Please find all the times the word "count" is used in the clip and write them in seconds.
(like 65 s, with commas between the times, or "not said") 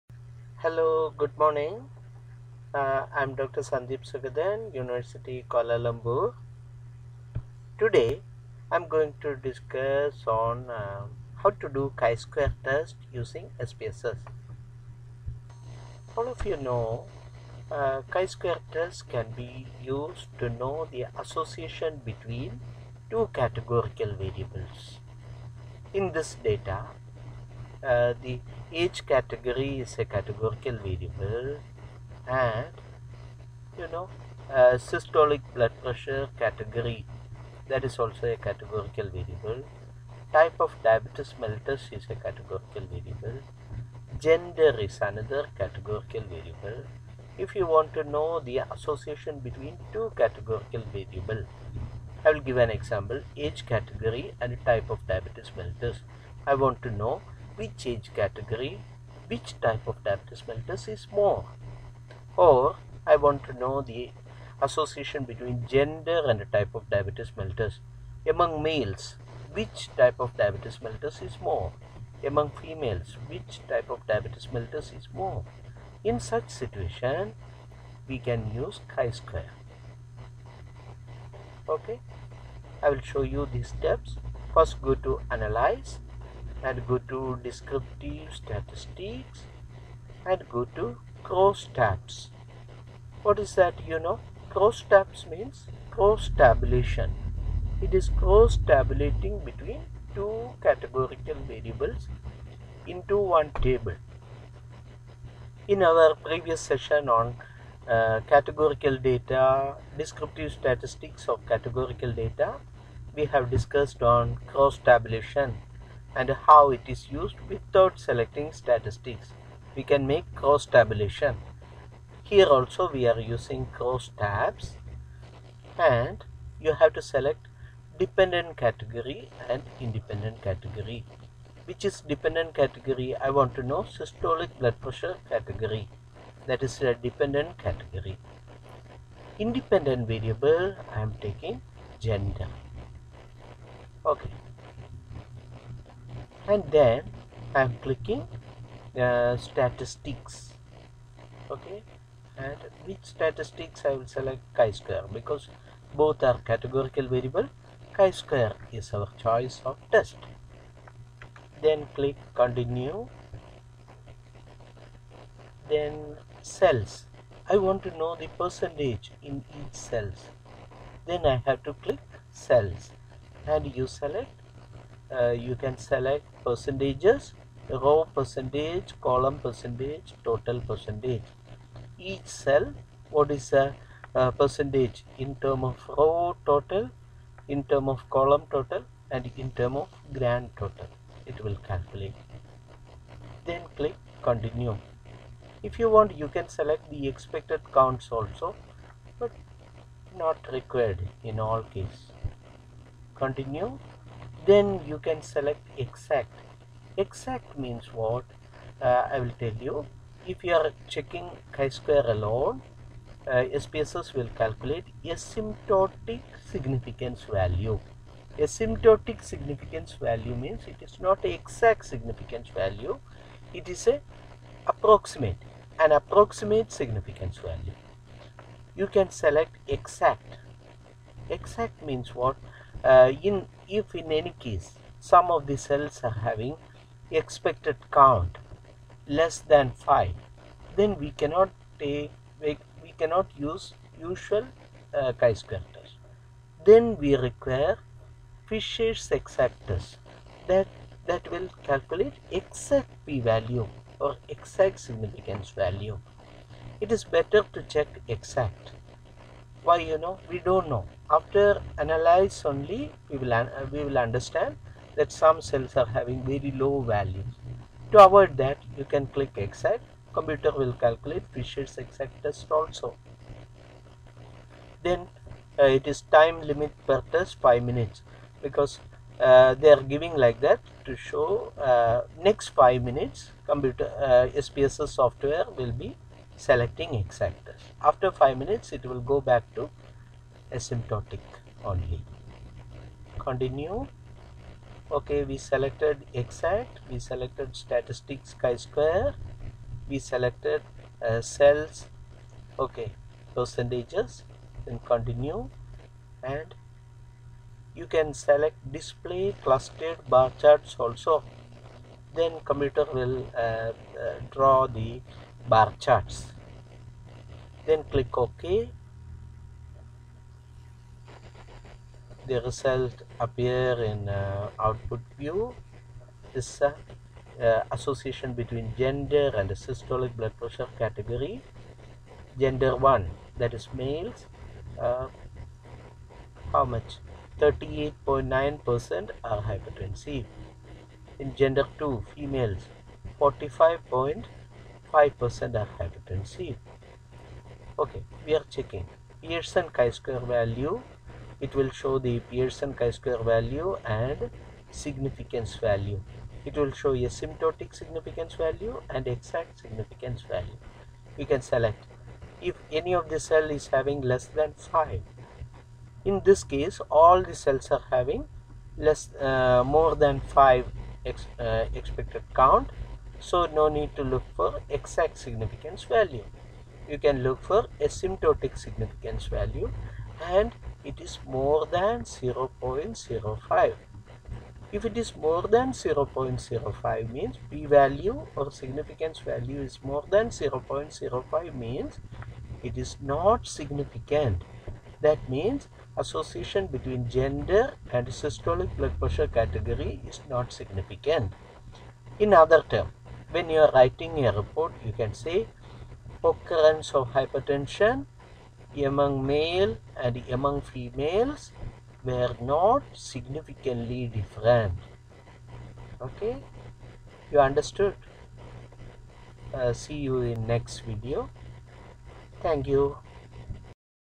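197 s, 237 s, 372 s.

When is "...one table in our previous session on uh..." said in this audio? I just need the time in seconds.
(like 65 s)
103 s.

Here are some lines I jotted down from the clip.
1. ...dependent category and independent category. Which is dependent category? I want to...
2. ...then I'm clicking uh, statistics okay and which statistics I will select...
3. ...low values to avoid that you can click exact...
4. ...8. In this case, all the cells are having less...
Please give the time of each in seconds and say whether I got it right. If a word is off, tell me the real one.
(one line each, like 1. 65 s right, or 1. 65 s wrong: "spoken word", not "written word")
1. 127 s right
2. 146 s right
3. 266 s right
4. 364 s wrong: "5", not "8".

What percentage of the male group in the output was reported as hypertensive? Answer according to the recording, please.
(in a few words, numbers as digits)
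38.9%.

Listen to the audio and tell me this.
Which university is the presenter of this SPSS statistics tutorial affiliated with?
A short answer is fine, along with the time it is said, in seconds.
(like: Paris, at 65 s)
University Kuala Lumpur, at 4 s.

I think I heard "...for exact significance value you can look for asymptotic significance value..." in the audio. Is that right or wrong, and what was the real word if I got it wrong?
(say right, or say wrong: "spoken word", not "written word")
right.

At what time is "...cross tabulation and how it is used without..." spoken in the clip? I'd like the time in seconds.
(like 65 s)
114 s.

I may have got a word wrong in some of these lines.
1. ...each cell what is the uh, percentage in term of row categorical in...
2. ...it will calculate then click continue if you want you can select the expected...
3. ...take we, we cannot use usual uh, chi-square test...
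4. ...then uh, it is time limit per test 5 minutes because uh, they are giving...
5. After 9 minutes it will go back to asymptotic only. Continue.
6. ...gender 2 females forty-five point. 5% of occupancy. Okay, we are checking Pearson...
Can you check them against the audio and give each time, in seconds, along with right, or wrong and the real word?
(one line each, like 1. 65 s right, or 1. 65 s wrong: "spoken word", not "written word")
1. 181 s wrong: "total", not "categorical"
2. 191 s right
3. 241 s right
4. 274 s right
5. 287 s wrong: "5", not "9"
6. 341 s right.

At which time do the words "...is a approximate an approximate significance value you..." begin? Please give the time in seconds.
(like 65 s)
223 s.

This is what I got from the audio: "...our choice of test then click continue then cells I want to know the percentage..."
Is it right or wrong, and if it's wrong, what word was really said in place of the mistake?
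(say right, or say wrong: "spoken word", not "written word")
right.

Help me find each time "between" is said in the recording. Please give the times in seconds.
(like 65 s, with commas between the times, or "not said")
22 s, 49 s, 65 s, 99 s, 328 s, 396 s.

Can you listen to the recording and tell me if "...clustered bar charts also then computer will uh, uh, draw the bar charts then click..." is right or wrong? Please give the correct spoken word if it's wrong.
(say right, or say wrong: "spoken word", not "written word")
right.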